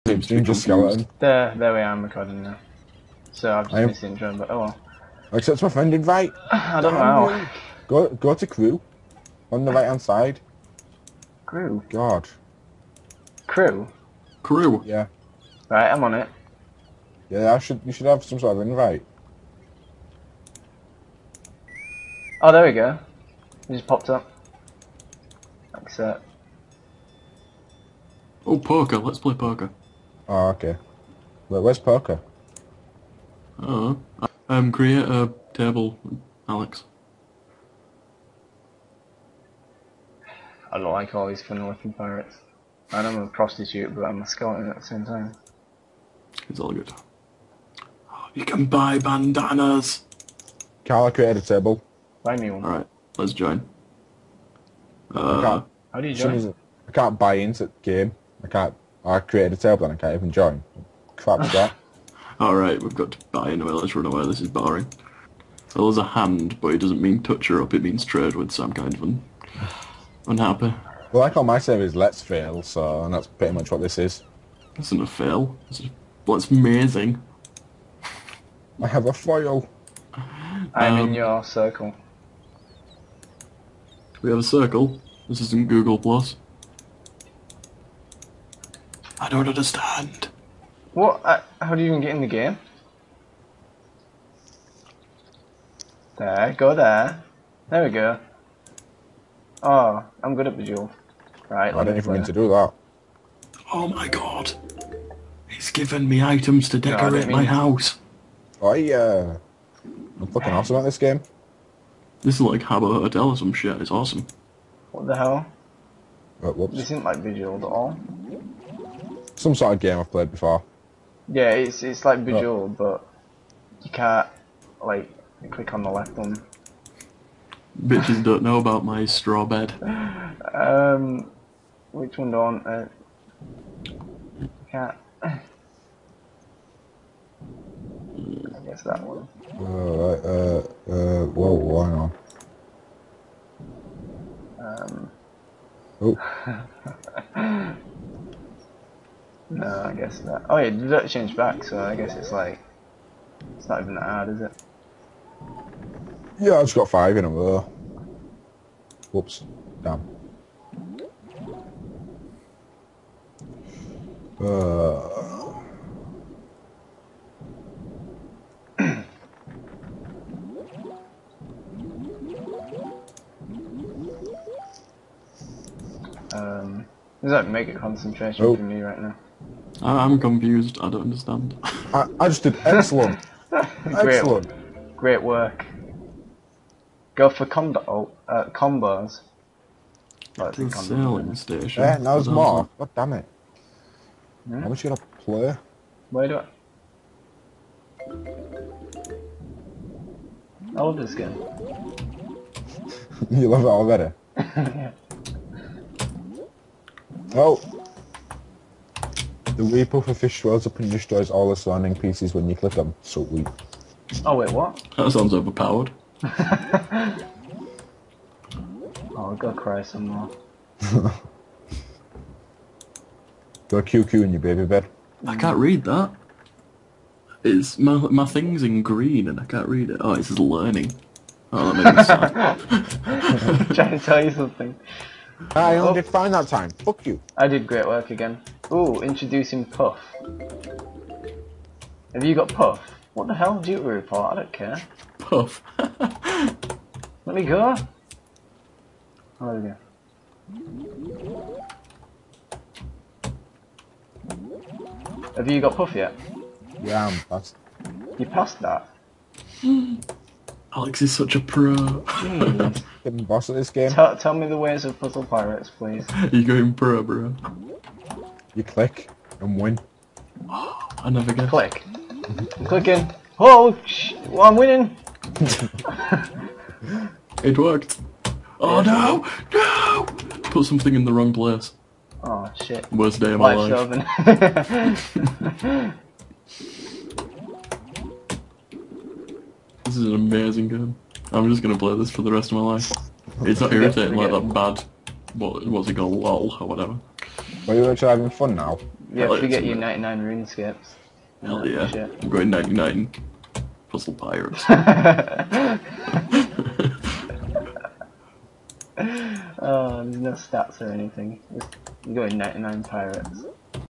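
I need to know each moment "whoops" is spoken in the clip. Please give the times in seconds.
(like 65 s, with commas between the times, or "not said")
116 s, 159 s.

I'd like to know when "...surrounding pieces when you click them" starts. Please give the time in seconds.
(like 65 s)
211 s.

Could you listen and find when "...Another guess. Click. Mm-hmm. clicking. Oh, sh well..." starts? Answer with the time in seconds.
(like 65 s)
271 s.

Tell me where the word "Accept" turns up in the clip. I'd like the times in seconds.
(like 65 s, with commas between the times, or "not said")
5 s, 25 s.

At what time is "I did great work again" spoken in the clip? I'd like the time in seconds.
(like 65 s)
237 s.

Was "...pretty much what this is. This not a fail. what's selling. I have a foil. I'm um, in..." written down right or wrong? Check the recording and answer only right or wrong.
wrong.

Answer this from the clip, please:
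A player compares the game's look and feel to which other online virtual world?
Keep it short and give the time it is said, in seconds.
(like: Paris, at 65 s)
Habbo Hotel, at 112 s.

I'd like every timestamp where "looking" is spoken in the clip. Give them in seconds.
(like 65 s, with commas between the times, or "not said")
41 s.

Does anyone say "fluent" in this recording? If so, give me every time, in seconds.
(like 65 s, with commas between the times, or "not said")
not said.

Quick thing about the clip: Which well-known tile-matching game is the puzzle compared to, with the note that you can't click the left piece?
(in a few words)
Bejeweled.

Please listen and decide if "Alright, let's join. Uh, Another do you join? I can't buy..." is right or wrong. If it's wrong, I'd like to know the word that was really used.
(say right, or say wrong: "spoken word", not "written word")
wrong: "How", not "Another".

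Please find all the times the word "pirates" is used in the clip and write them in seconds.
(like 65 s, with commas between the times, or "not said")
41 s, 265 s, 304 s, 312 s.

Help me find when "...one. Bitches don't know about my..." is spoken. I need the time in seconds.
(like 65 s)
126 s.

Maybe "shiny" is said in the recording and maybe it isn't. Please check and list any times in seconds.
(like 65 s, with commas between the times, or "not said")
not said.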